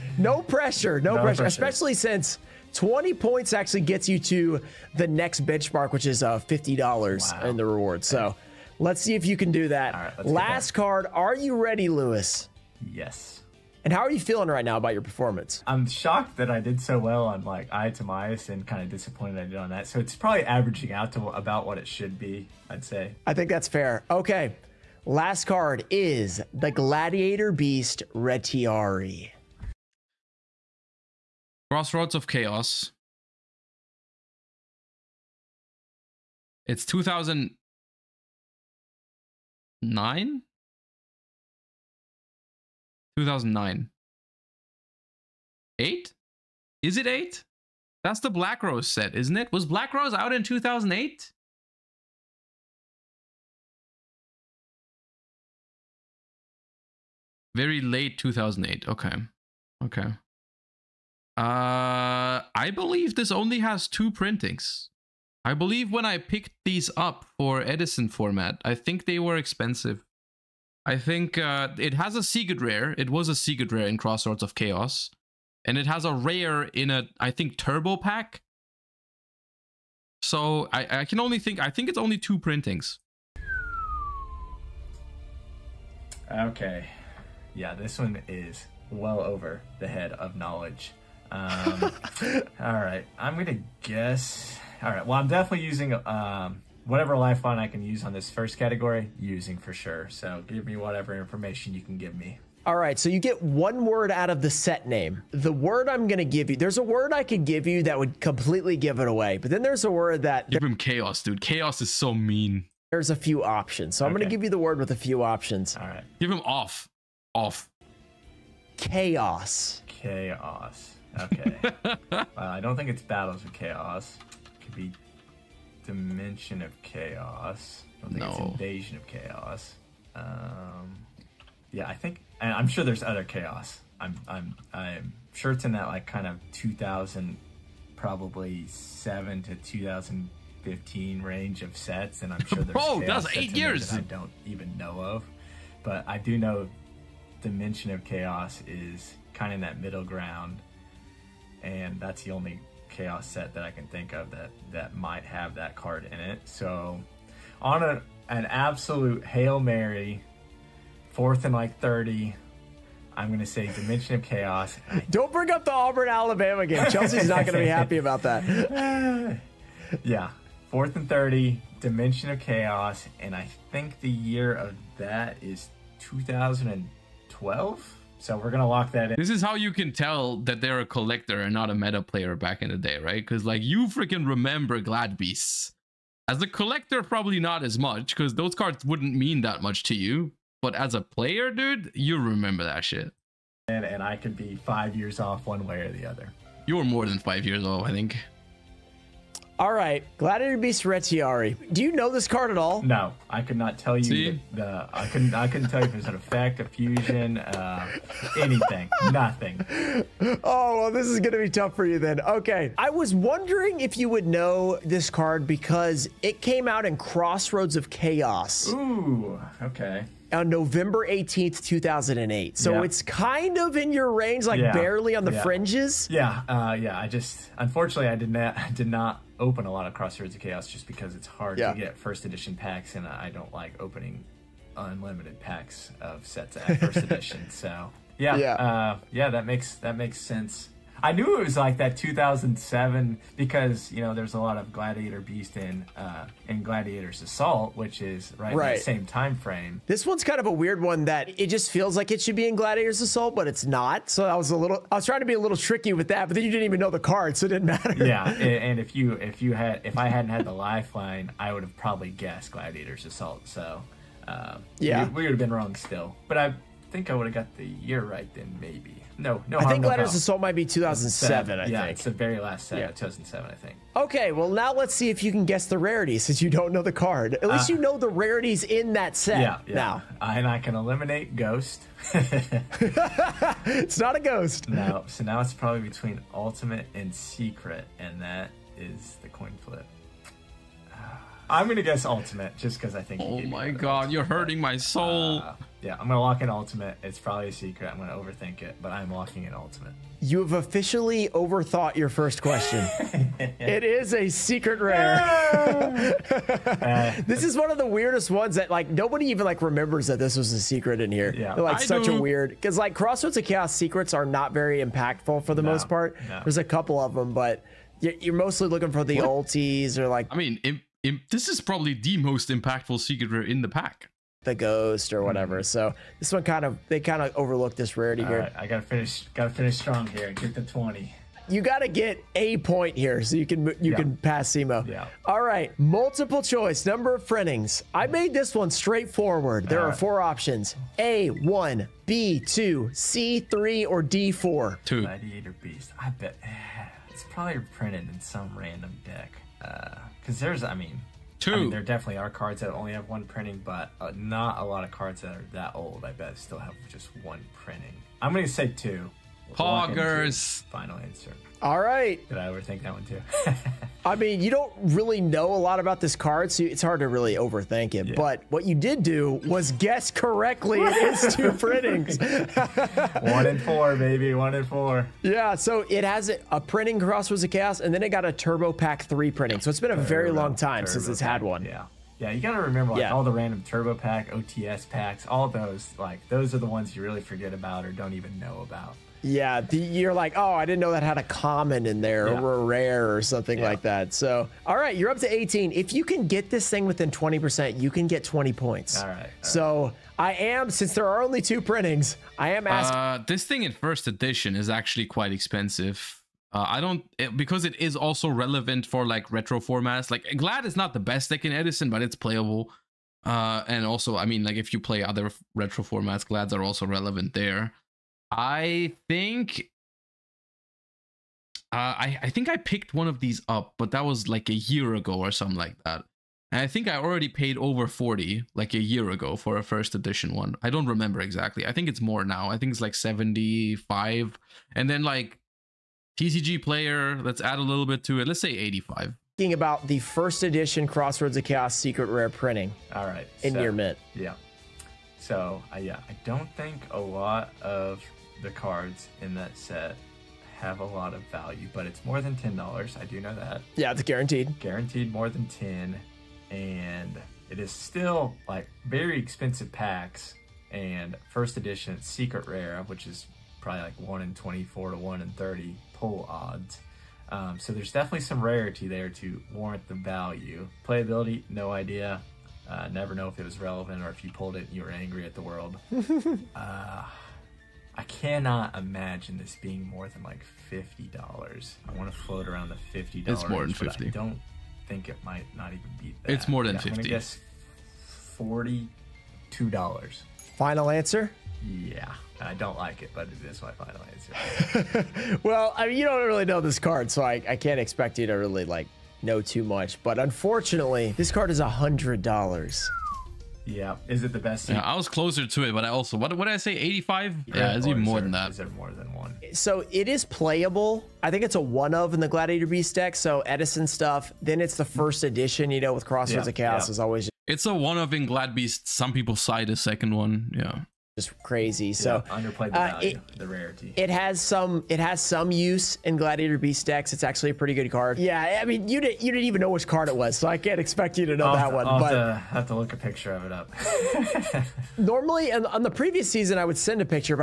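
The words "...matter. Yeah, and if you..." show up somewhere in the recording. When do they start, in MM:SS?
04:17.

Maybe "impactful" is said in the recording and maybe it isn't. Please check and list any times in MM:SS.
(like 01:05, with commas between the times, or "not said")
05:14, 05:22.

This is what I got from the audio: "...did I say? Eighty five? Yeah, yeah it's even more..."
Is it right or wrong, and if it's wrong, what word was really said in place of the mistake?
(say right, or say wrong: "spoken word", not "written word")
right.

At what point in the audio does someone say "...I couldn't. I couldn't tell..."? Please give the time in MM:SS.
03:24.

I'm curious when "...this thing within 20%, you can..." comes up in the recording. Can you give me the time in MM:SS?
06:36.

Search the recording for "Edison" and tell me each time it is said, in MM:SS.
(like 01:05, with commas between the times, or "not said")
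01:07, 06:51, 08:33.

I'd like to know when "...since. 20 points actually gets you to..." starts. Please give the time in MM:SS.
00:01.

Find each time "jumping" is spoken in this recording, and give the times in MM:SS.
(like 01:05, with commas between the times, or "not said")
not said.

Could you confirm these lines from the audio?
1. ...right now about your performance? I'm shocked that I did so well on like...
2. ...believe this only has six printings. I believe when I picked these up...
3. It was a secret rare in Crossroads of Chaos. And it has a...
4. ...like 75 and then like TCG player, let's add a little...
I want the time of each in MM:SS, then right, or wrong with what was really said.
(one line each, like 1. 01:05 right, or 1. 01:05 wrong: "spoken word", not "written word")
1. 00:14 right
2. 01:02 wrong: "two", not "six"
3. 01:12 right
4. 07:12 right.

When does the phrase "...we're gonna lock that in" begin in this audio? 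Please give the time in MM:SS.
02:58.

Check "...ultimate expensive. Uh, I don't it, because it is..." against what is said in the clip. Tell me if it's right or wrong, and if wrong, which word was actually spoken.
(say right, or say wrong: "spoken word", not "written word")
wrong: "quite", not "ultimate".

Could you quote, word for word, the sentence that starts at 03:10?
But as a player, dude, you remember that shit.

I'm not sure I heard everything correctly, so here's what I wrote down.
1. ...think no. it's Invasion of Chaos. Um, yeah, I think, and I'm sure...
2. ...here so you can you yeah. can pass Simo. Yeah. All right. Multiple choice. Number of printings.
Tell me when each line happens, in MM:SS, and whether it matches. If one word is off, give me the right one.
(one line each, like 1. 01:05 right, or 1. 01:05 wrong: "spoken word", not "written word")
1. 02:08 right
2. 05:32 right.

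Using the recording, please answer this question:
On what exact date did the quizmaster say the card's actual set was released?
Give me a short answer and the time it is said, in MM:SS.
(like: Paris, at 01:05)
November 18th, 2008, at 03:40.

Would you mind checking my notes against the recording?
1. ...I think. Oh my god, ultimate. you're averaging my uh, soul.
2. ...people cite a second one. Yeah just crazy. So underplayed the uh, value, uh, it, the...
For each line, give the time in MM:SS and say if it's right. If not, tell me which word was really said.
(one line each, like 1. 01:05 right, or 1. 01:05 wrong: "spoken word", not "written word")
1. 04:52 wrong: "hurting", not "averaging"
2. 08:39 right.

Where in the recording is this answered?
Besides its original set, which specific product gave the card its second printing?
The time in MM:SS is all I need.
06:18.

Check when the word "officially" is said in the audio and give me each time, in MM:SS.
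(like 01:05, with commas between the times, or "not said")
05:00.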